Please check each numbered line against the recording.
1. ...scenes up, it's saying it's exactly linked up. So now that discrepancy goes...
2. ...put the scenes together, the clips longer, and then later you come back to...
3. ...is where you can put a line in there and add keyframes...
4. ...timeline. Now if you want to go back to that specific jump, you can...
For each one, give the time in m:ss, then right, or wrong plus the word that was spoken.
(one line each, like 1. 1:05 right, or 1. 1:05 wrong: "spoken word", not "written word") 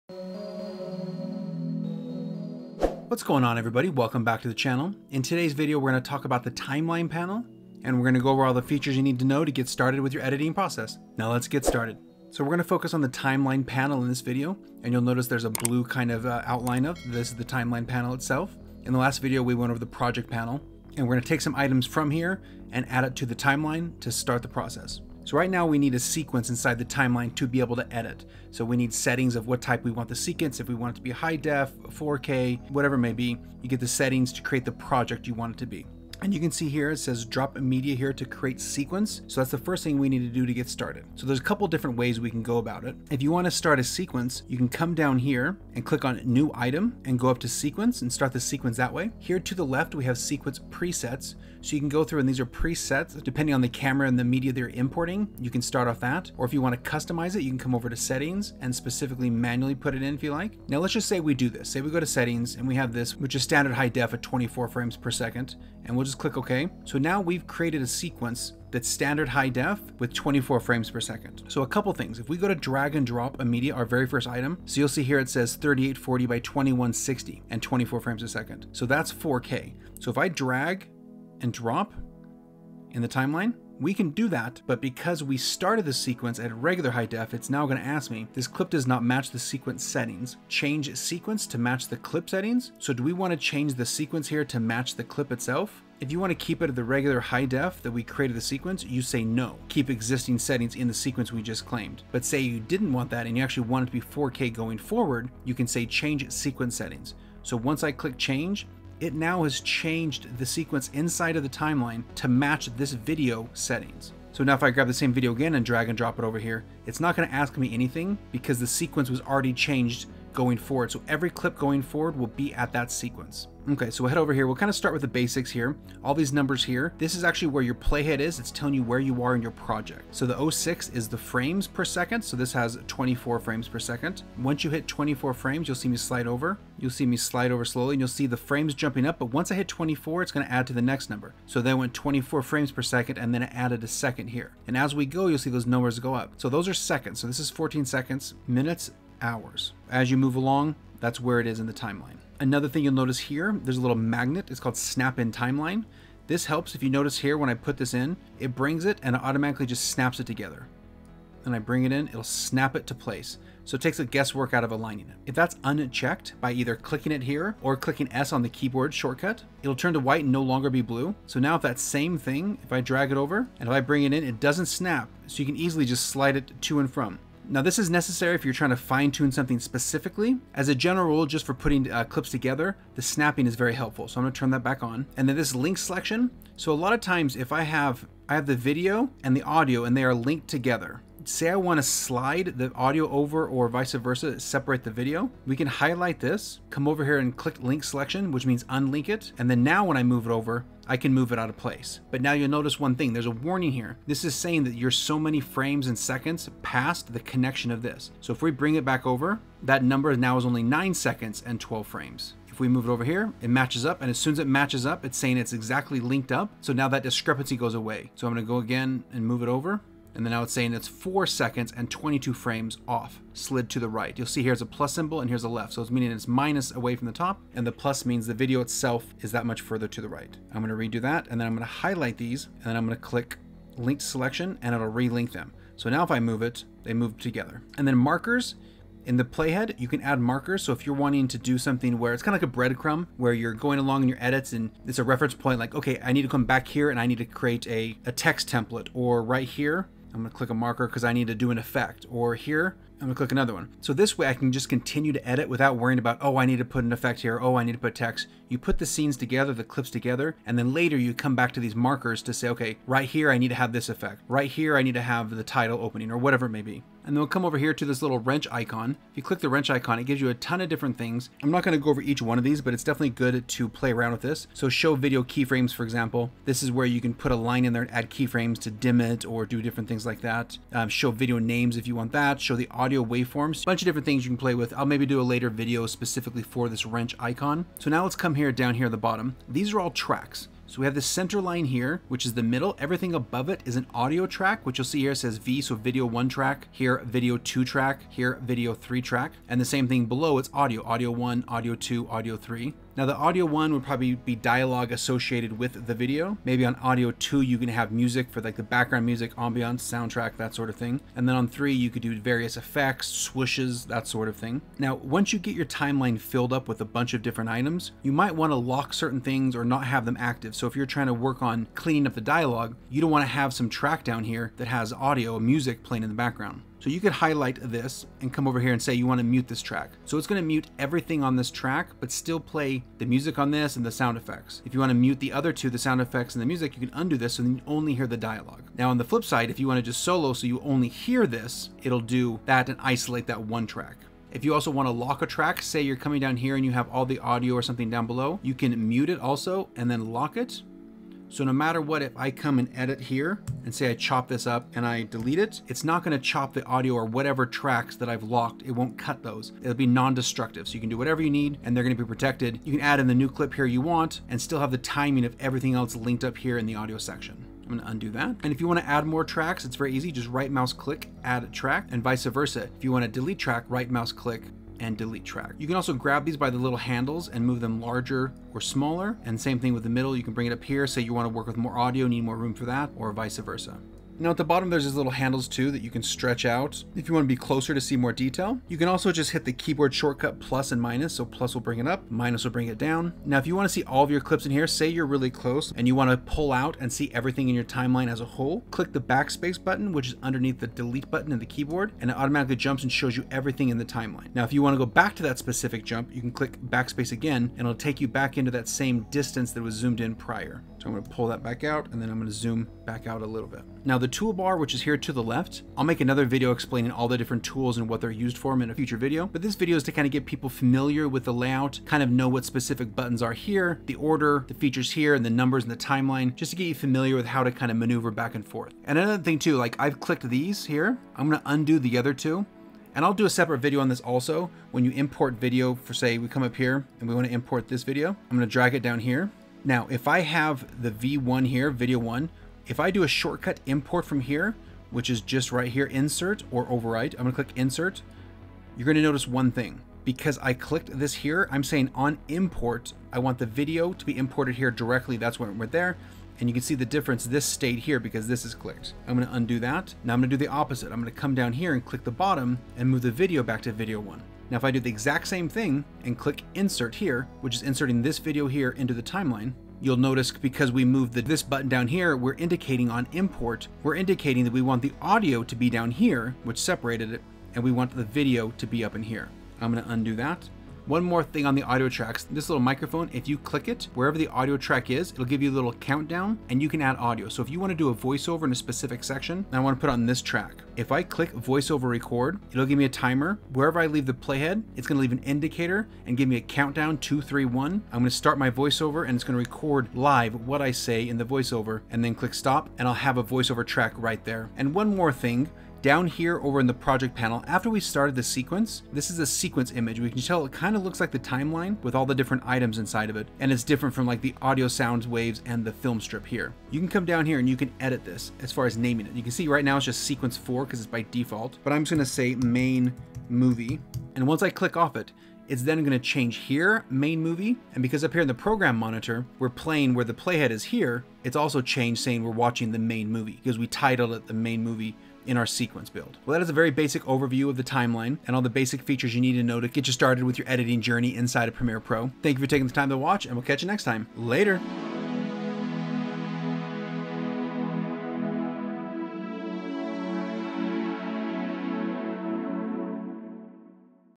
1. 3:34 wrong: "matches", not "scenes"
2. 4:18 wrong: "together", not "longer"
3. 4:36 right
4. 6:43 right.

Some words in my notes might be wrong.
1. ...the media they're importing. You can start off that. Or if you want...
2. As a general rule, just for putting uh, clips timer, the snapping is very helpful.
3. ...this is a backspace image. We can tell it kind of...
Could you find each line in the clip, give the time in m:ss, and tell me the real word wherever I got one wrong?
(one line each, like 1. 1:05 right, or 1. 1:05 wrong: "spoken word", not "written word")
1. 0:54 right
2. 3:00 wrong: "together", not "timer"
3. 8:28 wrong: "sequence", not "backspace".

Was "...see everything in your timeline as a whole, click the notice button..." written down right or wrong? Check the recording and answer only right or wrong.
wrong.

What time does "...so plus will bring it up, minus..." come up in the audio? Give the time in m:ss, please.
6:31.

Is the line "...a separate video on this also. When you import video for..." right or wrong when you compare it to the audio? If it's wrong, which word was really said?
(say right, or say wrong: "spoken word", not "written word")
right.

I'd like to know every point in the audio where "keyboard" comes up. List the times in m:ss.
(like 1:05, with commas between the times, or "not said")
2:48, 6:29, 6:41.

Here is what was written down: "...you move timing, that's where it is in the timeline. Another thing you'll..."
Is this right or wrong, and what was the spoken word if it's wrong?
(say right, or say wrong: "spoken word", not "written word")
wrong: "along", not "timing".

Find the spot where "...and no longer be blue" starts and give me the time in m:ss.
2:50.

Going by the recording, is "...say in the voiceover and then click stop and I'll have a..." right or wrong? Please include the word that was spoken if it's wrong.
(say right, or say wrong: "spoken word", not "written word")
right.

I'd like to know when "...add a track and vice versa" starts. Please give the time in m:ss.
6:11.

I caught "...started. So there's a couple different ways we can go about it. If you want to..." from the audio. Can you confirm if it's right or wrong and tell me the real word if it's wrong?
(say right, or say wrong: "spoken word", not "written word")
right.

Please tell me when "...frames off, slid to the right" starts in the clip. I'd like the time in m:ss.
3:42.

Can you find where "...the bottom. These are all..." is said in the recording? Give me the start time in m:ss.
4:48.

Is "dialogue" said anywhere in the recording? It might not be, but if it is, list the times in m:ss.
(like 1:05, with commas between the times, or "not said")
5:04, 5:22, 5:38.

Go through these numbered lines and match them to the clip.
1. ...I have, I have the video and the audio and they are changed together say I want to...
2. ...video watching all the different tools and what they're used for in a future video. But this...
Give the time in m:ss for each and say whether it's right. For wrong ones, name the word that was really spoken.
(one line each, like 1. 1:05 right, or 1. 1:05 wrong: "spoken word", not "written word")
1. 3:07 wrong: "linked", not "changed"
2. 6:56 wrong: "explaining", not "watching".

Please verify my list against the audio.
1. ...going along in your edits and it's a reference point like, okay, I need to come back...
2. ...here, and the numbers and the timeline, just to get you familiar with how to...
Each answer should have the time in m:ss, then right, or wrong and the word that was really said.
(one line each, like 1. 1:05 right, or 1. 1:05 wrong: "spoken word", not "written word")
1. 4:03 right
2. 7:04 right.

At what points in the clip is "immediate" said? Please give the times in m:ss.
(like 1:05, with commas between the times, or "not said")
1:13.